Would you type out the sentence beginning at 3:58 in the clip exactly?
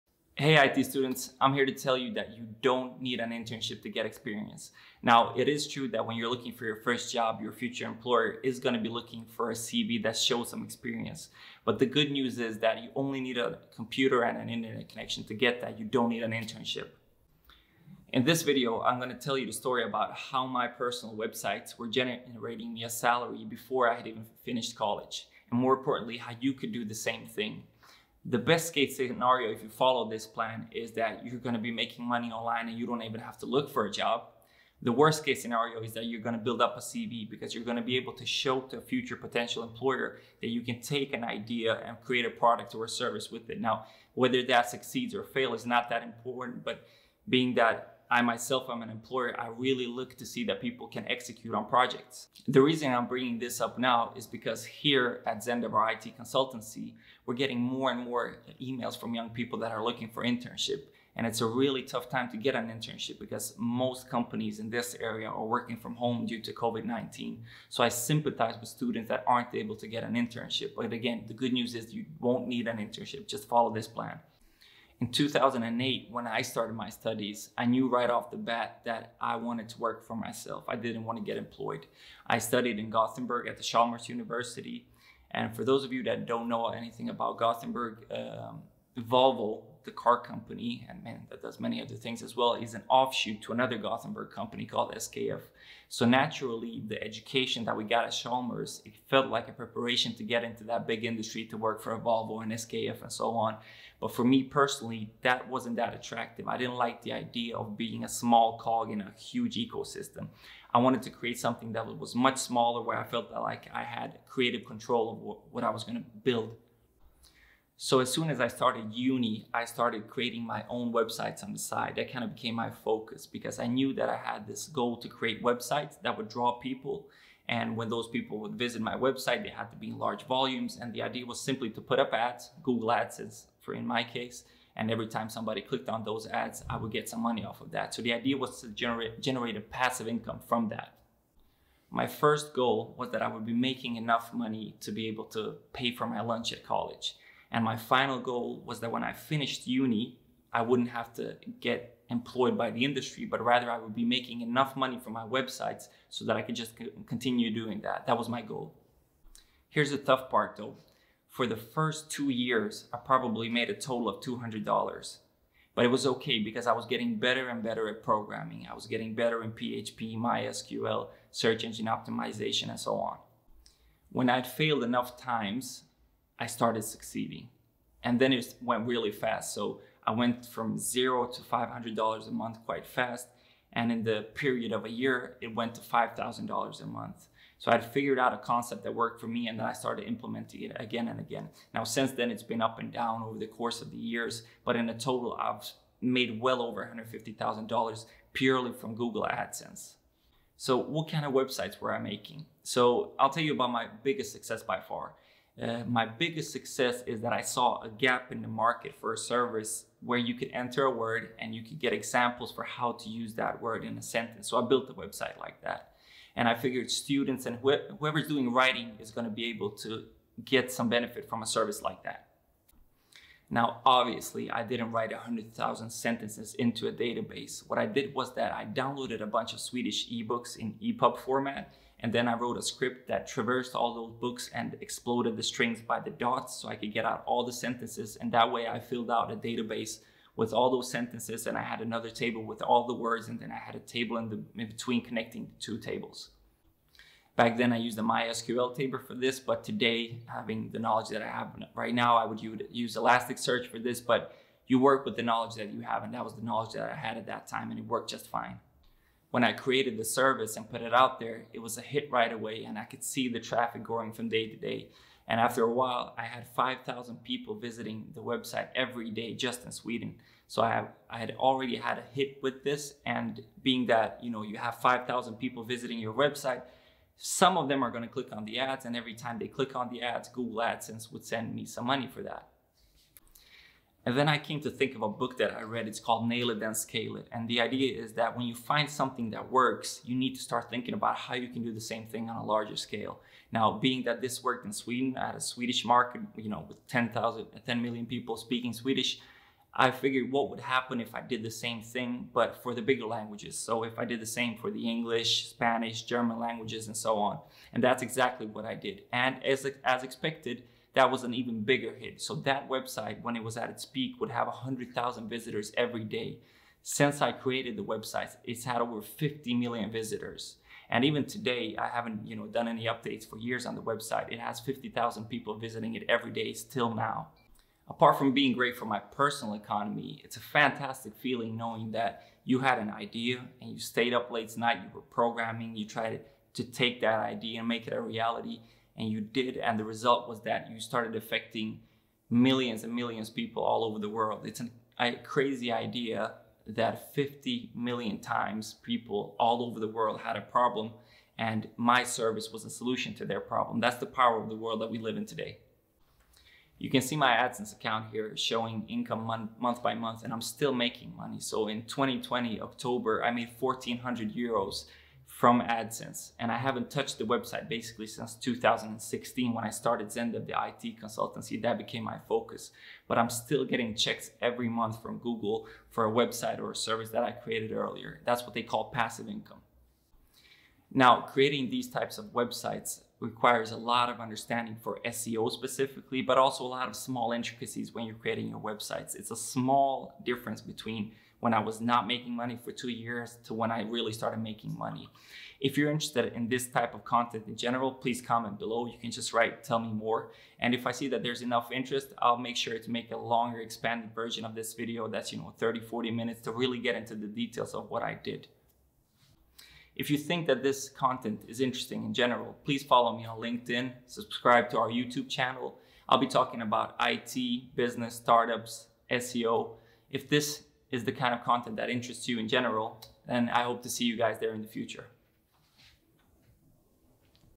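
And that way I filled out a database with all those sentences.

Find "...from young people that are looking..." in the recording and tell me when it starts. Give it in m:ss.
0:58.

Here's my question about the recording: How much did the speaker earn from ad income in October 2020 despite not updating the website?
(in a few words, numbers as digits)
1,400 euros.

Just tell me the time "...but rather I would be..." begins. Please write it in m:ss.
2:33.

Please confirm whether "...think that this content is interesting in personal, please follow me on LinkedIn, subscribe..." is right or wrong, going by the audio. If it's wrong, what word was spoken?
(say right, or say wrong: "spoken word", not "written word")
wrong: "general", not "personal".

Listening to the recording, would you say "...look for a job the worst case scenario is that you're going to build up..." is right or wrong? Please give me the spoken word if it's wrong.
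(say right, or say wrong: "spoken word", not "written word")
right.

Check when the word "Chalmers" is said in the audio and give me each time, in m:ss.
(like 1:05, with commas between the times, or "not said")
1:23, 1:38.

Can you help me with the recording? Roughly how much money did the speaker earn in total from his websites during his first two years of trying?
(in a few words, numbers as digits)
$200.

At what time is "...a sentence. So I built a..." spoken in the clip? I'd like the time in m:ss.
3:33.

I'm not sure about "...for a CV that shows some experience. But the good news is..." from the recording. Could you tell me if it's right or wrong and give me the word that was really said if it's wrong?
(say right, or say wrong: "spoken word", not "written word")
right.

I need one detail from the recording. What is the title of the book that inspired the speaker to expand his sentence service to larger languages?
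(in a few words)
Nail It Then Scale It.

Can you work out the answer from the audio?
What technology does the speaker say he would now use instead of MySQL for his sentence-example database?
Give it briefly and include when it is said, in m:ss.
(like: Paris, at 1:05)
Elasticsearch, at 4:12.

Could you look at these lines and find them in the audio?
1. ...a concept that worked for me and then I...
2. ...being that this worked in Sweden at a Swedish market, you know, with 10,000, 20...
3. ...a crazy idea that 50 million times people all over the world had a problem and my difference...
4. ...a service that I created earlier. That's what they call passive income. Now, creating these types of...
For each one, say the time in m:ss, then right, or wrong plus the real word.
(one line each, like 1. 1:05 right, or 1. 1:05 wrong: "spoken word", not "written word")
1. 3:08 right
2. 4:53 wrong: "10", not "20"
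3. 5:44 wrong: "service", not "difference"
4. 6:16 right.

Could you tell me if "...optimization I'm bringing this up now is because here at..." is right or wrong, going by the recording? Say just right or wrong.
wrong.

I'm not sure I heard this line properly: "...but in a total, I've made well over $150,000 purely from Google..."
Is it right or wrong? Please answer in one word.
right.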